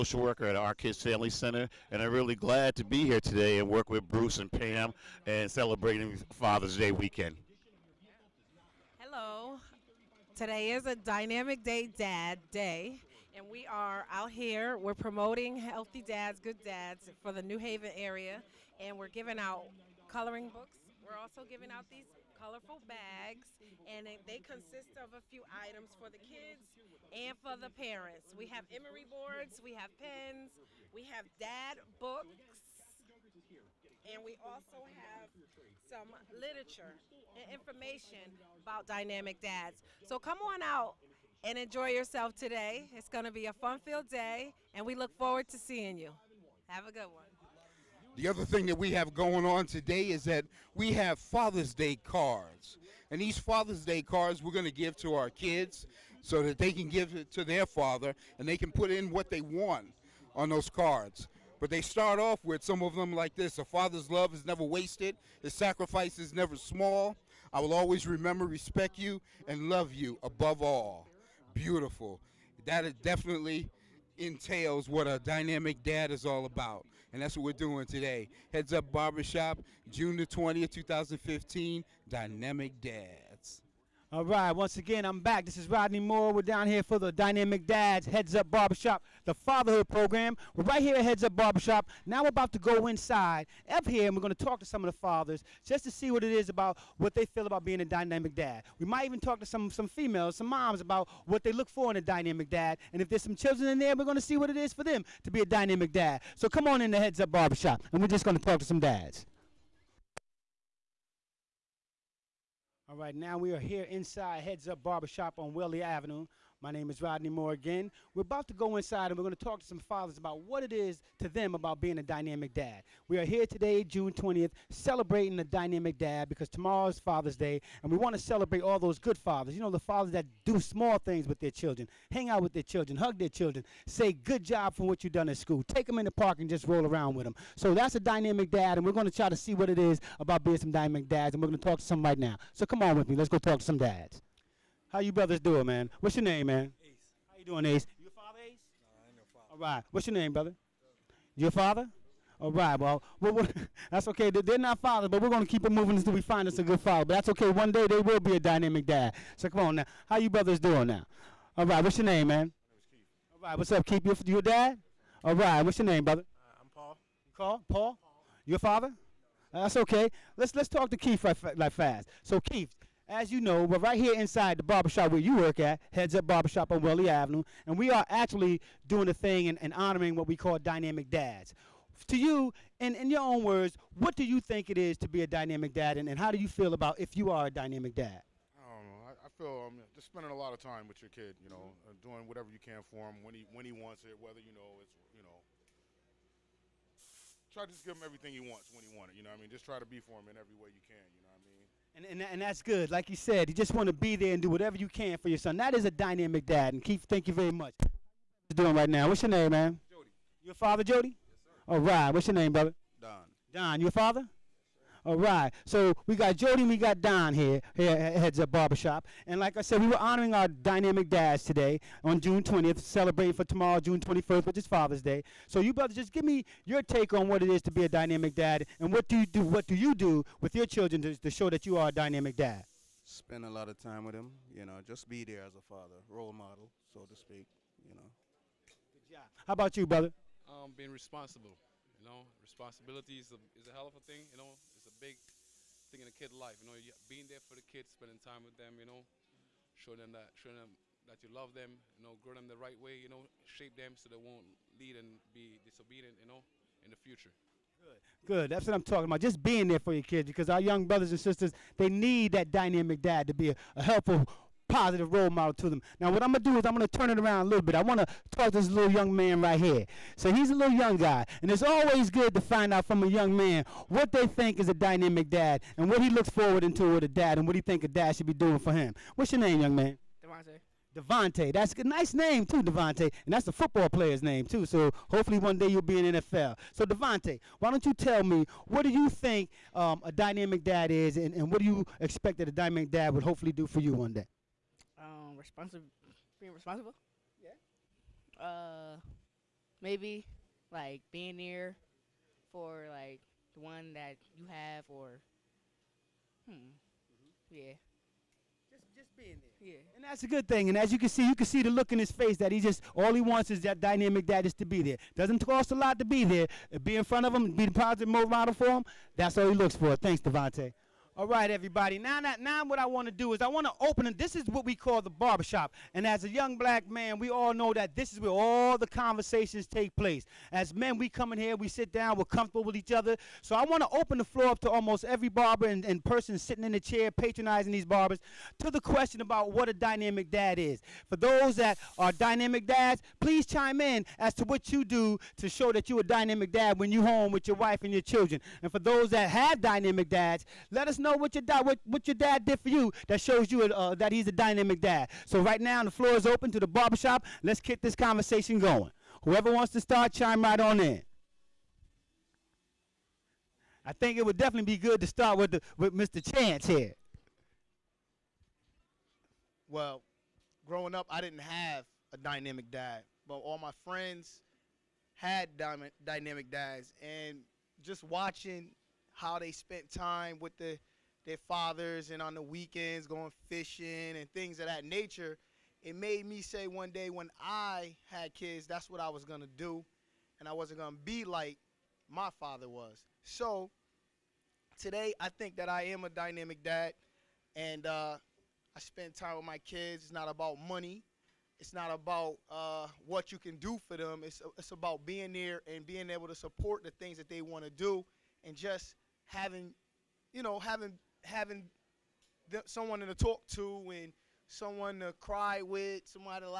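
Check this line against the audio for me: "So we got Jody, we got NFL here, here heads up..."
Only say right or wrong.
wrong.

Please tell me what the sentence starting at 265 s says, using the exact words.
Now, what I'm going to do is I'm going to turn it around a little bit.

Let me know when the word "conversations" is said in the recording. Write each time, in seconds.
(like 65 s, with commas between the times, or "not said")
328 s, 357 s.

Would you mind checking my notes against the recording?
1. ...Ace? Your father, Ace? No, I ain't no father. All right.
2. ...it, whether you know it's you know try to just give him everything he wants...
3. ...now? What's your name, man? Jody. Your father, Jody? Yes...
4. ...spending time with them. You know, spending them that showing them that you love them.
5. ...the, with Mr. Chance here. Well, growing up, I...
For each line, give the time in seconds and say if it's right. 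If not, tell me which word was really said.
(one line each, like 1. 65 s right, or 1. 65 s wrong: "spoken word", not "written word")
1. 147 s right
2. 194 s right
3. 208 s right
4. 247 s wrong: "showing", not "spending"
5. 365 s right.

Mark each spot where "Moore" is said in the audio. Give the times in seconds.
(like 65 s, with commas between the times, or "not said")
85 s, 117 s.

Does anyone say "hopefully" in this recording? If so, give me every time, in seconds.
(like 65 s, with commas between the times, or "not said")
285 s, 293 s.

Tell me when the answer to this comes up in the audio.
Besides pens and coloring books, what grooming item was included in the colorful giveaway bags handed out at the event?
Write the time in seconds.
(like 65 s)
28 s.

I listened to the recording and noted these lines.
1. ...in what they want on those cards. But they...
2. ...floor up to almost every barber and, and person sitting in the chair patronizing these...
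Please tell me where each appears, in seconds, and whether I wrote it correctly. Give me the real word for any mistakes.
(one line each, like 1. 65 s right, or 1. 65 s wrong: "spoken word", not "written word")
1. 58 s right
2. 334 s right.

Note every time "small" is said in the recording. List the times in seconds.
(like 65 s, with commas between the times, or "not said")
66 s, 130 s.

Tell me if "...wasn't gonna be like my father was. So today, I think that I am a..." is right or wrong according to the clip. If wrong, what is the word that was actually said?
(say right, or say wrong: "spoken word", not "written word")
right.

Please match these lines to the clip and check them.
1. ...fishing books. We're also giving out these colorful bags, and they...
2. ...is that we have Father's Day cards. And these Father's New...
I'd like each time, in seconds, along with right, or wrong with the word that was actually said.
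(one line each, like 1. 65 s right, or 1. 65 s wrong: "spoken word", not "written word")
1. 20 s wrong: "coloring", not "fishing"
2. 50 s wrong: "Day", not "New".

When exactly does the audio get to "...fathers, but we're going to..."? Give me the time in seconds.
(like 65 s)
154 s.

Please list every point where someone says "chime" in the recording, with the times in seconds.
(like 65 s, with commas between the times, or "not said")
343 s, 360 s.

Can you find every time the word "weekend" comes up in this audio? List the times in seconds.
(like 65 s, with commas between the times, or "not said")
6 s, 382 s.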